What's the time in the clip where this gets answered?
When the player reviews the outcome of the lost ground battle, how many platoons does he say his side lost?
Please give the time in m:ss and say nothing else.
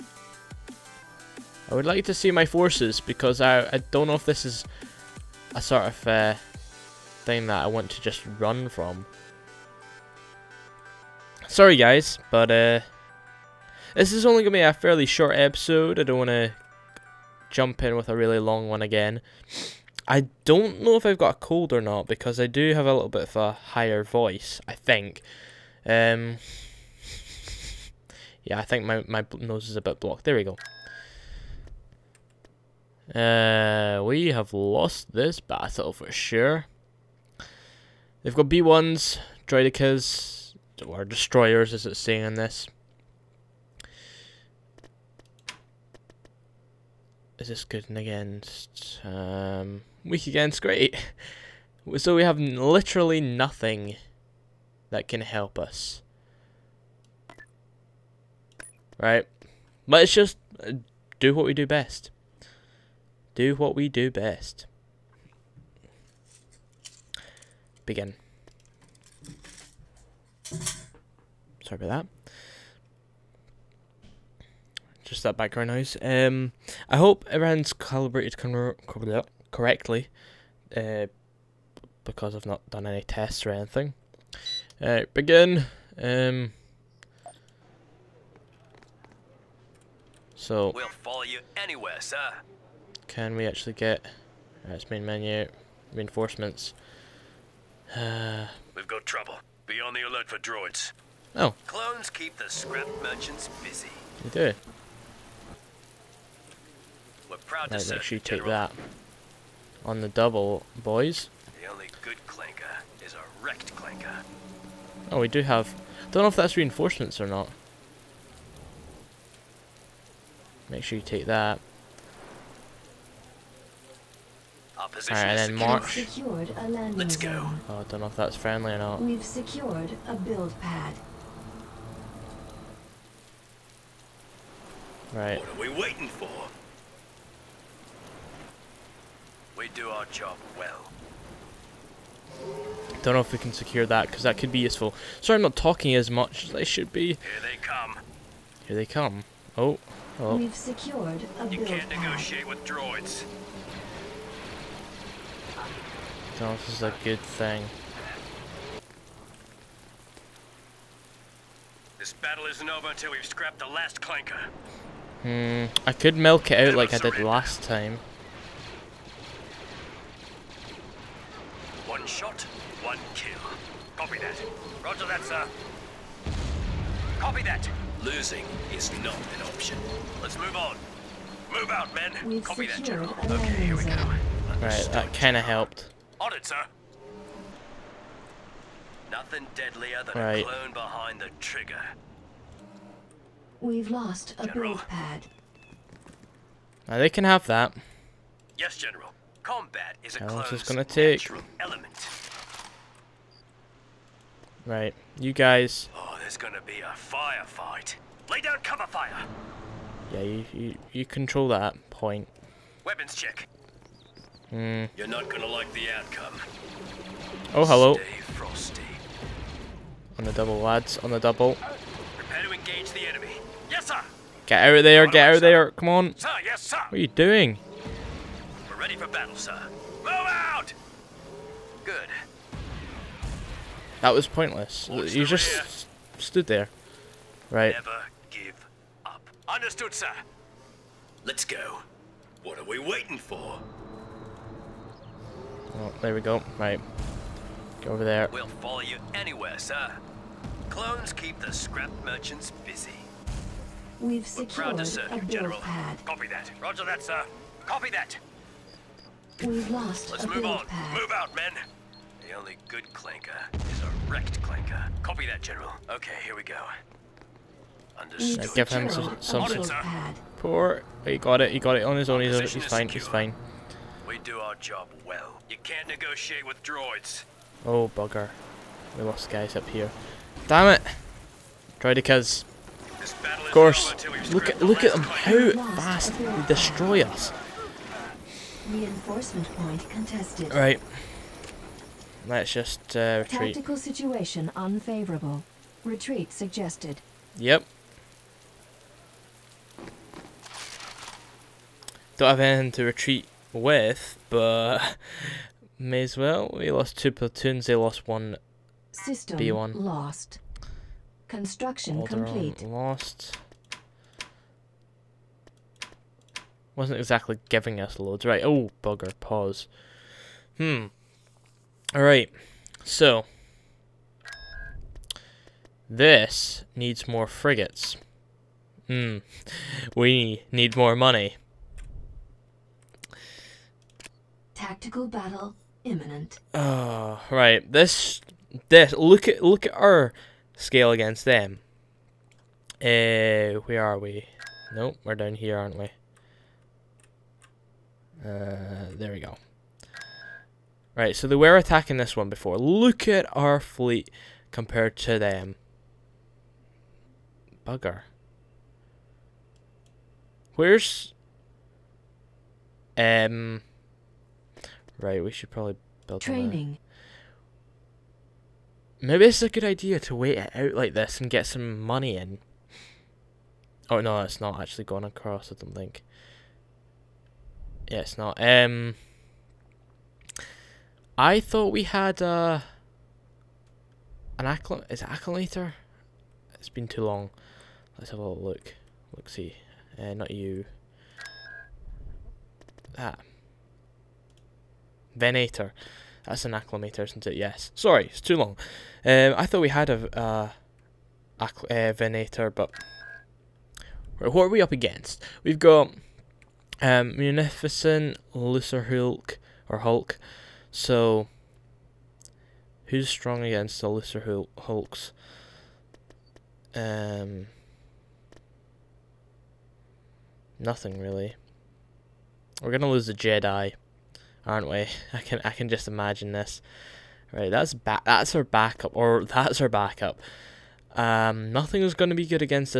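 5:06.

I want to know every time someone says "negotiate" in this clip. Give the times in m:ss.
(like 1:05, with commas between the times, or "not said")
2:31, 4:35.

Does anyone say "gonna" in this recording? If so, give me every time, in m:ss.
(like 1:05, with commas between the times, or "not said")
3:20, 3:26, 3:35, 7:02, 7:11.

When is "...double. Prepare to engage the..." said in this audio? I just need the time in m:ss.
3:41.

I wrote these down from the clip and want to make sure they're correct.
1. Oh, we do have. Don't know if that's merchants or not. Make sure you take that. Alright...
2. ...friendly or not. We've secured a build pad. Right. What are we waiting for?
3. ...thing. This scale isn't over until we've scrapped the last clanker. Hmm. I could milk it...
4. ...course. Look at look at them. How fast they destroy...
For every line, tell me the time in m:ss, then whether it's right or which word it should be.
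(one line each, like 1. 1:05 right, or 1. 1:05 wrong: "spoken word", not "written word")
1. 1:55 wrong: "reinforcements", not "merchants"
2. 2:08 right
3. 2:37 wrong: "battle", not "scale"
4. 4:43 right.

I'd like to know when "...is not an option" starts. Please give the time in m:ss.
2:58.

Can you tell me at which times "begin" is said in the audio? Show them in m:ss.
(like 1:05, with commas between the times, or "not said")
1:07, 1:25.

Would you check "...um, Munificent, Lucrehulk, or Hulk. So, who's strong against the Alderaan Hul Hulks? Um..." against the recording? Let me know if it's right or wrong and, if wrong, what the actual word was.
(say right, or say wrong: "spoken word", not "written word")
wrong: "Lucer", not "Alderaan".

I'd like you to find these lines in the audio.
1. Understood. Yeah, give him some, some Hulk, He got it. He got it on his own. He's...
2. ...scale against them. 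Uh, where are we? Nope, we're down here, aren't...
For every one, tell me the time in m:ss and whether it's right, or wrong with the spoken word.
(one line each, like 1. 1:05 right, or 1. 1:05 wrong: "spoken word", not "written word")
1. 4:27 wrong: "Poor", not "Hulk"
2. 5:40 right.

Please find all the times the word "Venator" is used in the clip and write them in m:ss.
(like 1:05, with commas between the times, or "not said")
6:35, 6:41.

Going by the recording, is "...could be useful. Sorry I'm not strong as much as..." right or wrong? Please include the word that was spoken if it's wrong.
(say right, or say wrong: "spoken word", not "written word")
wrong: "talking", not "strong".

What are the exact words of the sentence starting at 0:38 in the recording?
They've got B1s, Droidekas, or Destroyers as it's saying in this.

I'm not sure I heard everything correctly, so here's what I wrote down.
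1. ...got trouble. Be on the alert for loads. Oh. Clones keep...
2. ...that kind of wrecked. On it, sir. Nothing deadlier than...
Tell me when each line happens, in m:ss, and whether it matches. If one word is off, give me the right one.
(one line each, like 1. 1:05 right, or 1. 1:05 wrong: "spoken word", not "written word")
1. 1:38 wrong: "droids", not "loads"
2. 3:04 wrong: "helped", not "wrecked".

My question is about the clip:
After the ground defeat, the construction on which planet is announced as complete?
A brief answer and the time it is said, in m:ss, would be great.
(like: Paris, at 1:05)
Alderaan, at 5:11.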